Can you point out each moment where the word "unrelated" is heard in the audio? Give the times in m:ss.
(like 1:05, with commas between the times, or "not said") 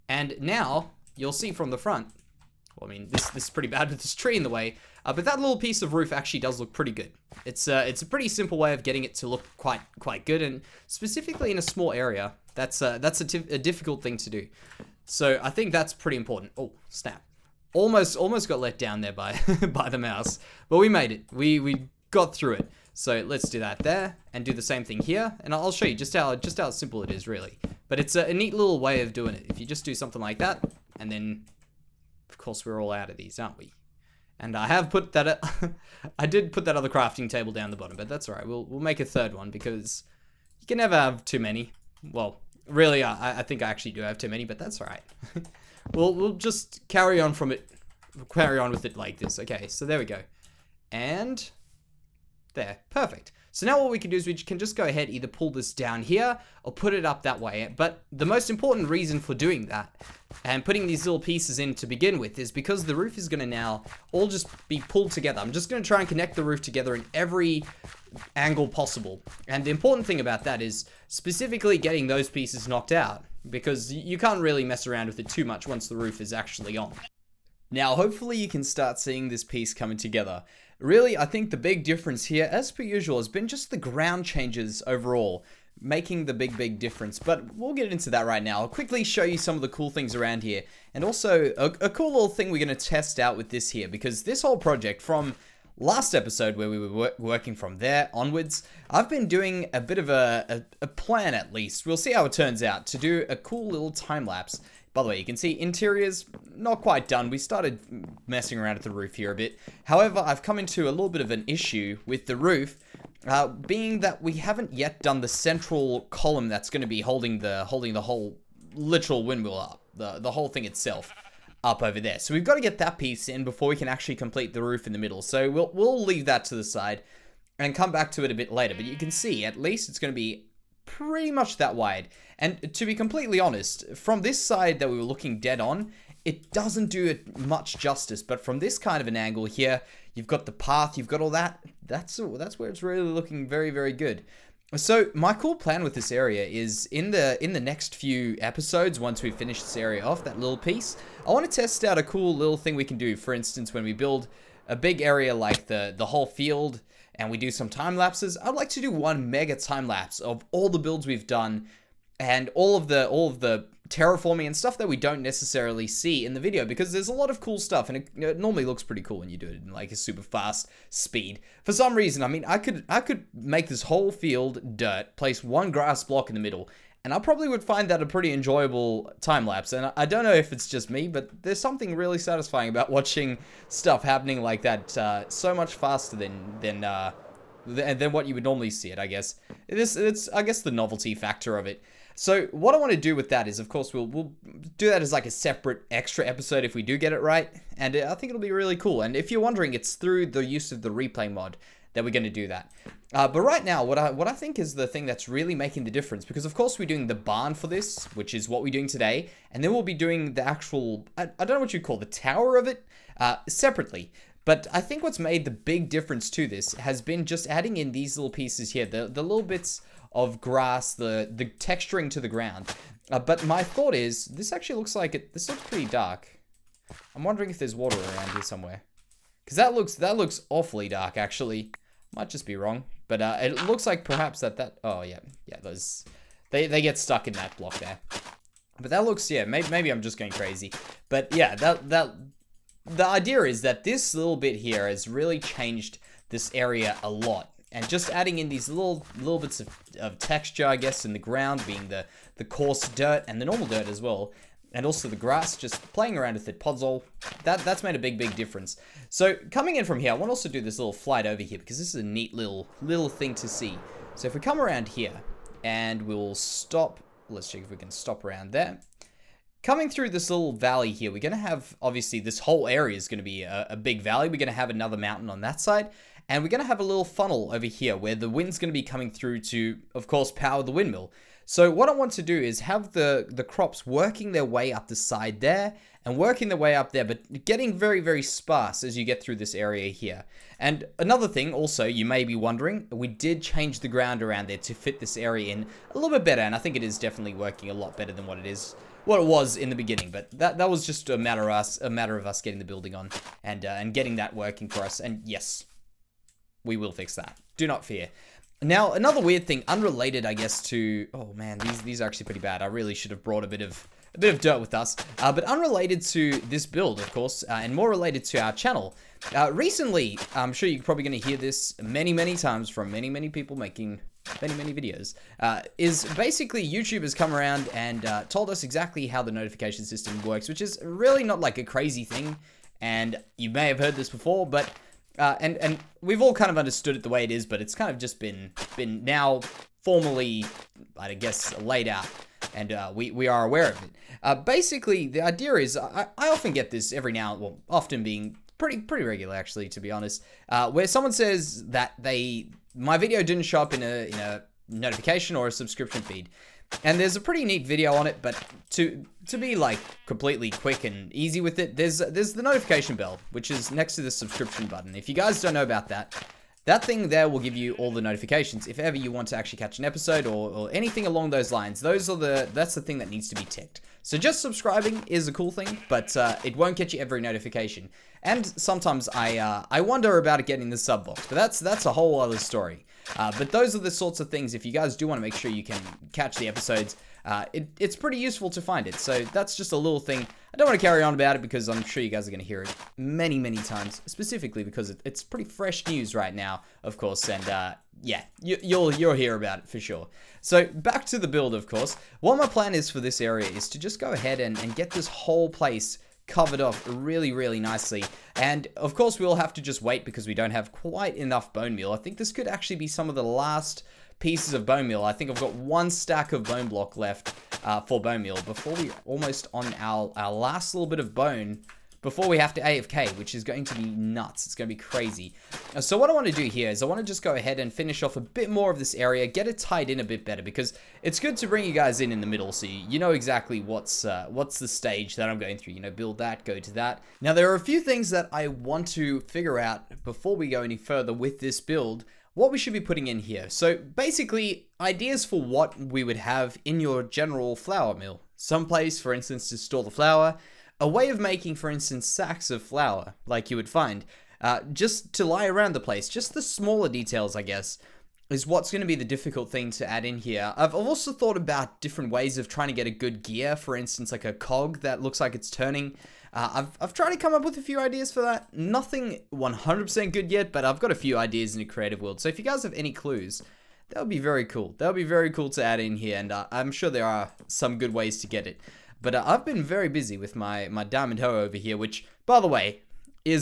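5:09, 5:15.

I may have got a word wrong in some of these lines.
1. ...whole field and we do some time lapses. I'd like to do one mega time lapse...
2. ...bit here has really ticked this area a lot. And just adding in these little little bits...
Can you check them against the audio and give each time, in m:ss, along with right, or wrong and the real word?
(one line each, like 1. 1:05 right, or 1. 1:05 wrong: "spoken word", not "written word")
1. 2:36 right
2. 4:04 wrong: "changed", not "ticked".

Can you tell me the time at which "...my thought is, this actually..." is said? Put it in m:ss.
3:43.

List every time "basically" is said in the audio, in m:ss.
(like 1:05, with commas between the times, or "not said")
5:26, 5:44, 7:23.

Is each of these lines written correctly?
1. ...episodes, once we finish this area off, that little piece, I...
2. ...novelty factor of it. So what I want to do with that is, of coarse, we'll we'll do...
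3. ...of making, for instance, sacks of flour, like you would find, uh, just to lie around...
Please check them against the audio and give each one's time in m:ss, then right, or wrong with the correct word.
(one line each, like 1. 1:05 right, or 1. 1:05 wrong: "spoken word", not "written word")
1. 2:28 right
2. 3:10 wrong: "course", not "coarse"
3. 7:31 right.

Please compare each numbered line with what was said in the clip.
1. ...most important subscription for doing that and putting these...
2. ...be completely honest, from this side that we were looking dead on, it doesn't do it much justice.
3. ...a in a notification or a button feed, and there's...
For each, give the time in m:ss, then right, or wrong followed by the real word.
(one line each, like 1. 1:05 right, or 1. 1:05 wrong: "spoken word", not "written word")
1. 0:58 wrong: "reason", not "subscription"
2. 2:12 right
3. 5:53 wrong: "subscription", not "button".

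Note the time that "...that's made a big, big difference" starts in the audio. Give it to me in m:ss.
4:17.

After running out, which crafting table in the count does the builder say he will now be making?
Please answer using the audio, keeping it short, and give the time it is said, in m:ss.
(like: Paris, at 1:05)
third, at 0:39.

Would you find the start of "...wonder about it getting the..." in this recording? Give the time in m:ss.
6:19.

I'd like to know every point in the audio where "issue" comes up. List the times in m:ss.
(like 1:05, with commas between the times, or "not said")
1:51.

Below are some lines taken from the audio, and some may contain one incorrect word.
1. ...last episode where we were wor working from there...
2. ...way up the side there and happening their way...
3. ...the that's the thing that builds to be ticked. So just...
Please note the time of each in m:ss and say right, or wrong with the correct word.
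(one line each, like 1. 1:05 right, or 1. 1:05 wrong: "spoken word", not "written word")
1. 1:35 right
2. 4:44 wrong: "working", not "happening"
3. 6:12 wrong: "needs", not "builds".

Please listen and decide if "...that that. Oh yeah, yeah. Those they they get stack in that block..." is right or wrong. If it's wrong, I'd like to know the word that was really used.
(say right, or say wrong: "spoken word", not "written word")
wrong: "stuck", not "stack".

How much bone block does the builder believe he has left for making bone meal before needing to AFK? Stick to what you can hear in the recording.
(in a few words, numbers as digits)
one stack.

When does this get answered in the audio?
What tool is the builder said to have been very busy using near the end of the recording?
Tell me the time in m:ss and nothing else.
8:00.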